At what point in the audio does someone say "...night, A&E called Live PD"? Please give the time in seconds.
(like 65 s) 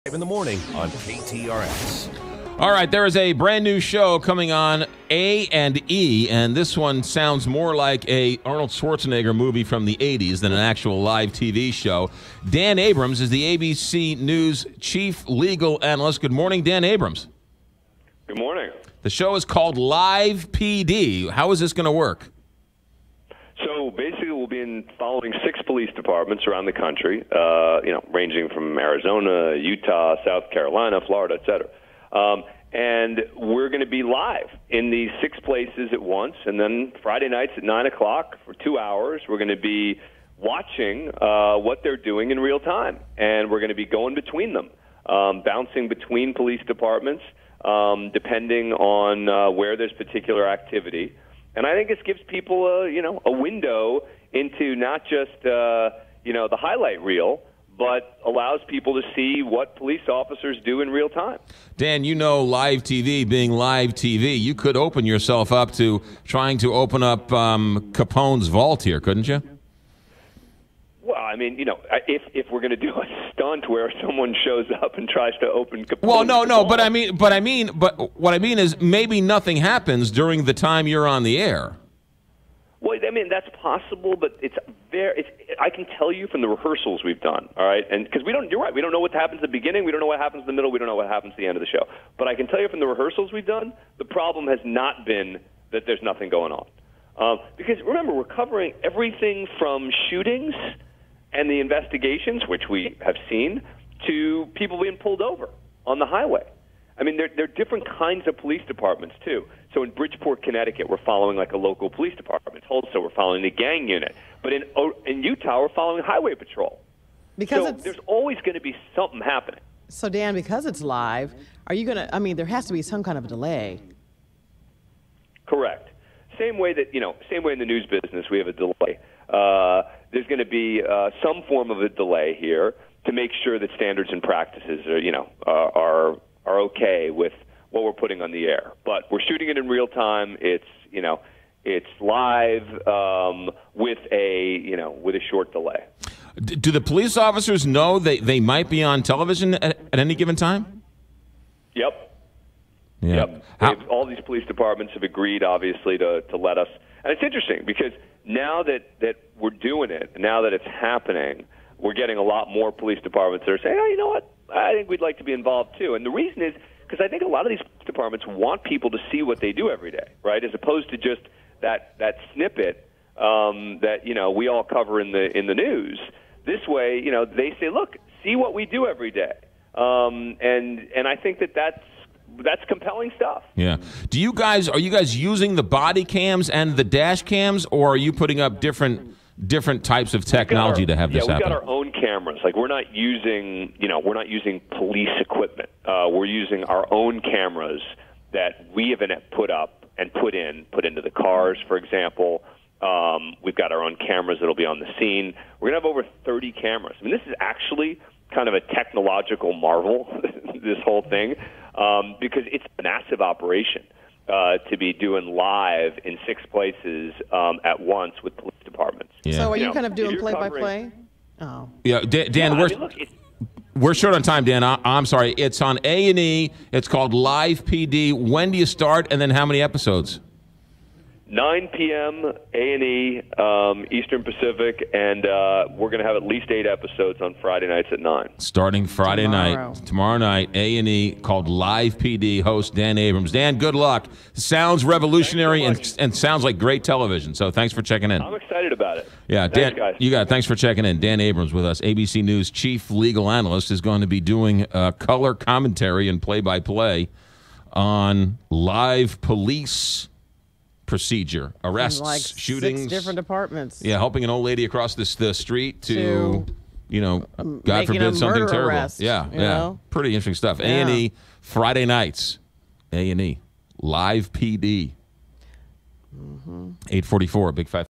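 240 s.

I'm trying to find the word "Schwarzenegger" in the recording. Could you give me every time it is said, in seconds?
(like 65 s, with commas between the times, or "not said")
8 s.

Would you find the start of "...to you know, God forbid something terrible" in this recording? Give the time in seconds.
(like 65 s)
265 s.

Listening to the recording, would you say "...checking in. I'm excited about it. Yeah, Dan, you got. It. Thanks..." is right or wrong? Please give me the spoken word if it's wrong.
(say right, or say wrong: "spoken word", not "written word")
right.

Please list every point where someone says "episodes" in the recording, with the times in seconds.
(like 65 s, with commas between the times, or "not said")
229 s, 236 s.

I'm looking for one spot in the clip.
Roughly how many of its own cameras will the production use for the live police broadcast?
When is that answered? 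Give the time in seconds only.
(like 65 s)
205 s.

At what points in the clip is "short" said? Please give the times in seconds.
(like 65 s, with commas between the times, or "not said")
145 s, 223 s.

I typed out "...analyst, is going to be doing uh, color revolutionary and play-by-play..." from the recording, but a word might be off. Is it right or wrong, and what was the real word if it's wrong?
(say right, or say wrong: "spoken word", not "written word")
wrong: "commentary", not "revolutionary".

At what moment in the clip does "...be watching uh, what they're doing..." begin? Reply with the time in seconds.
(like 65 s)
39 s.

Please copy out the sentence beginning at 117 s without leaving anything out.
Because so there's always going to be something happening.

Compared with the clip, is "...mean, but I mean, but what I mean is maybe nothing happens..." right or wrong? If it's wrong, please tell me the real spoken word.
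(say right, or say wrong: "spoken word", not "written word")
right.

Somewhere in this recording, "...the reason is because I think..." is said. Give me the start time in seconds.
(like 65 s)
166 s.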